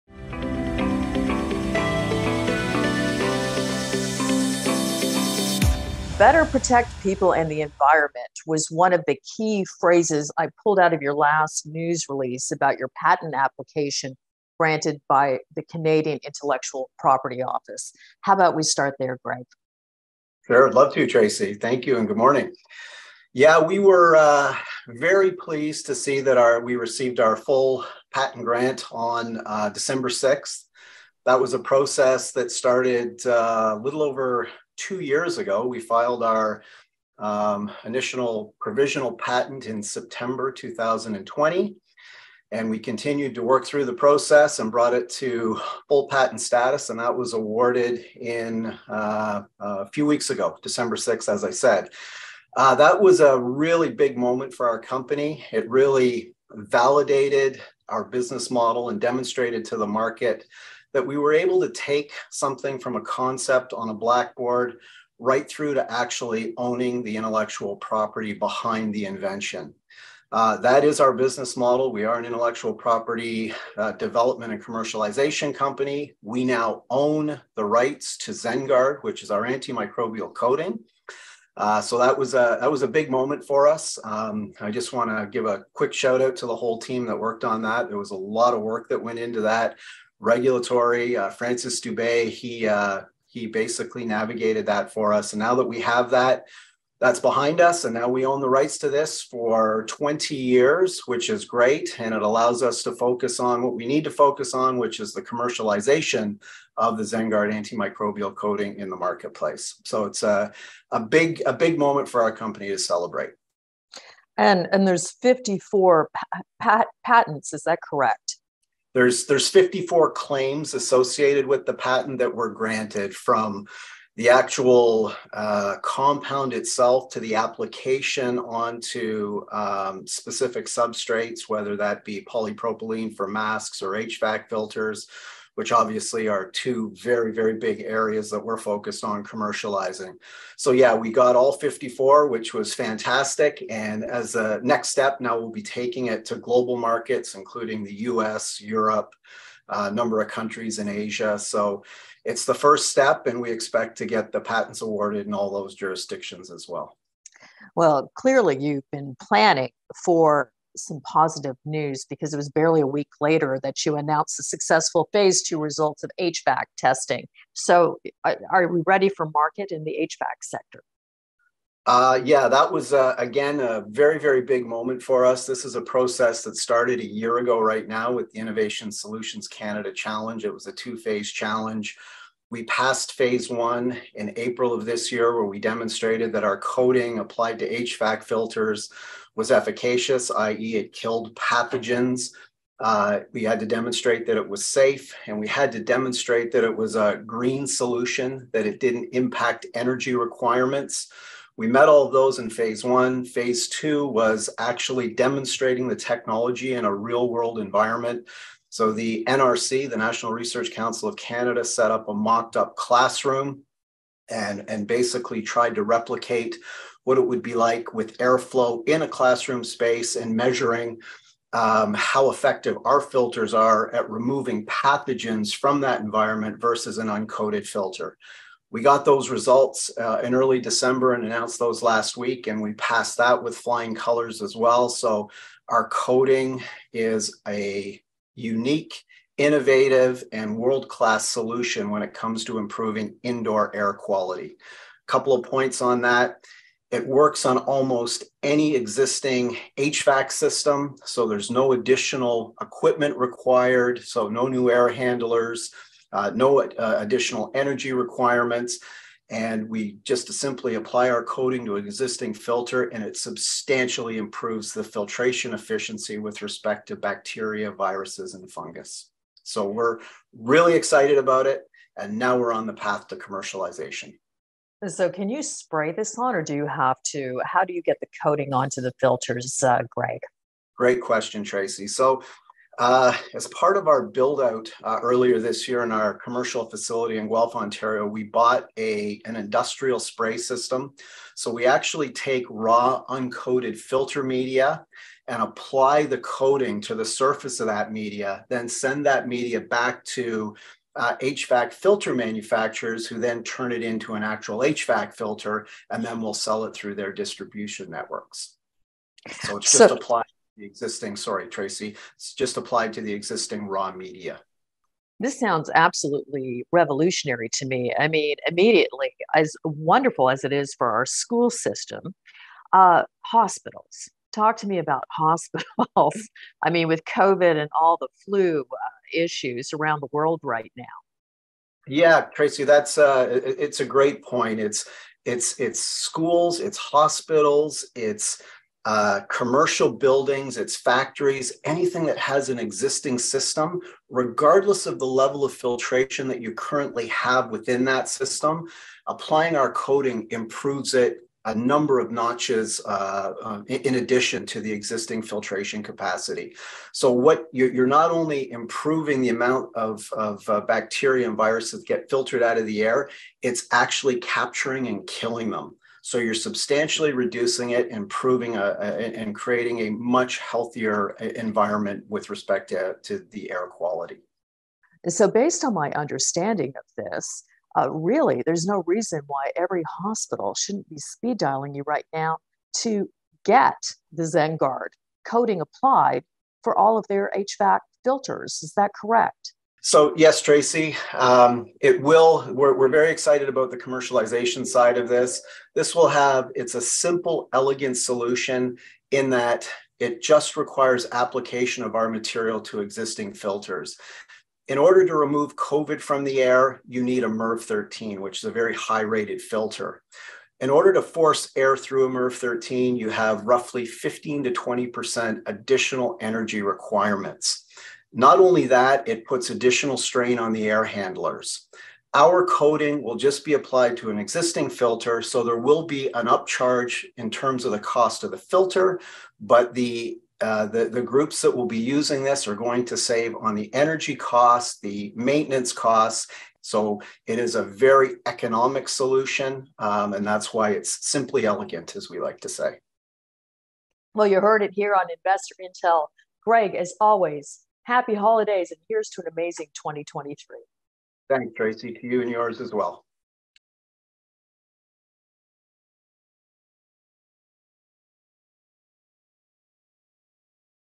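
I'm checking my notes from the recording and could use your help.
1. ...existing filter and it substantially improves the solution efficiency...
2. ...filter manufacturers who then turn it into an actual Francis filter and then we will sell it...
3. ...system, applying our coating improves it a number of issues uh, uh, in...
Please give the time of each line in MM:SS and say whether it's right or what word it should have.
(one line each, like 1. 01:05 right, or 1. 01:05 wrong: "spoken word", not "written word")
1. 04:21 wrong: "filtration", not "solution"
2. 05:01 wrong: "HVAC", not "Francis"
3. 05:48 wrong: "notches", not "issues".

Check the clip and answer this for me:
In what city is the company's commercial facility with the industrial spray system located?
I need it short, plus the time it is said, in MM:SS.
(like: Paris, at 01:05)
Guelph, Ontario, at 04:47.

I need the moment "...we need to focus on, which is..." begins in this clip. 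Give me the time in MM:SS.
01:43.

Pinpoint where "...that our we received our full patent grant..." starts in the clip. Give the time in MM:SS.
00:26.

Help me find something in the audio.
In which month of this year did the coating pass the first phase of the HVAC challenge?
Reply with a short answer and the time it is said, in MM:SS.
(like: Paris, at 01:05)
April, at 03:04.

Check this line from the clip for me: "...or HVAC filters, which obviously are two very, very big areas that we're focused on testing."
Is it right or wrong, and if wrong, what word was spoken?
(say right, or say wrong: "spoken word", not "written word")
wrong: "commercializing", not "testing".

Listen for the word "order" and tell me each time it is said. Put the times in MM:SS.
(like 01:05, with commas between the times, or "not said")
06:44, 06:50.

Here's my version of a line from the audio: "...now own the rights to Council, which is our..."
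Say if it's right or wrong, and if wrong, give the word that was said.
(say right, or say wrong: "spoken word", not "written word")
wrong: "ZenGuard", not "Council".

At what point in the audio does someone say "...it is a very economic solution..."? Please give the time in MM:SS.
07:17.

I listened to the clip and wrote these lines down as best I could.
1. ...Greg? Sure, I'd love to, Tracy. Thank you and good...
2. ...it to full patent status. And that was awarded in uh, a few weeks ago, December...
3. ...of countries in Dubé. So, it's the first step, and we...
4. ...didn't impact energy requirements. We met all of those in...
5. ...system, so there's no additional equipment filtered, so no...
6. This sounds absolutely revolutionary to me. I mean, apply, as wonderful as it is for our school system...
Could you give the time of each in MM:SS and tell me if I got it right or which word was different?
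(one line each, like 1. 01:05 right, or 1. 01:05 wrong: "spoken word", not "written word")
1. 00:19 right
2. 00:44 right
3. 02:30 wrong: "Asia", not "Dubé"
4. 03:18 right
5. 04:10 wrong: "required", not "filtered"
6. 05:15 wrong: "immediately", not "apply".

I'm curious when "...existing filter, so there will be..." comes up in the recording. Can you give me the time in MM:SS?
07:04.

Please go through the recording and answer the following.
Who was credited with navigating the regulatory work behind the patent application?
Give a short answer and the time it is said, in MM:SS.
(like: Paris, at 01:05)
Francis Dubé, at 01:31.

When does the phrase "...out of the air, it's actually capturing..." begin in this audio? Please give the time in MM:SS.
06:02.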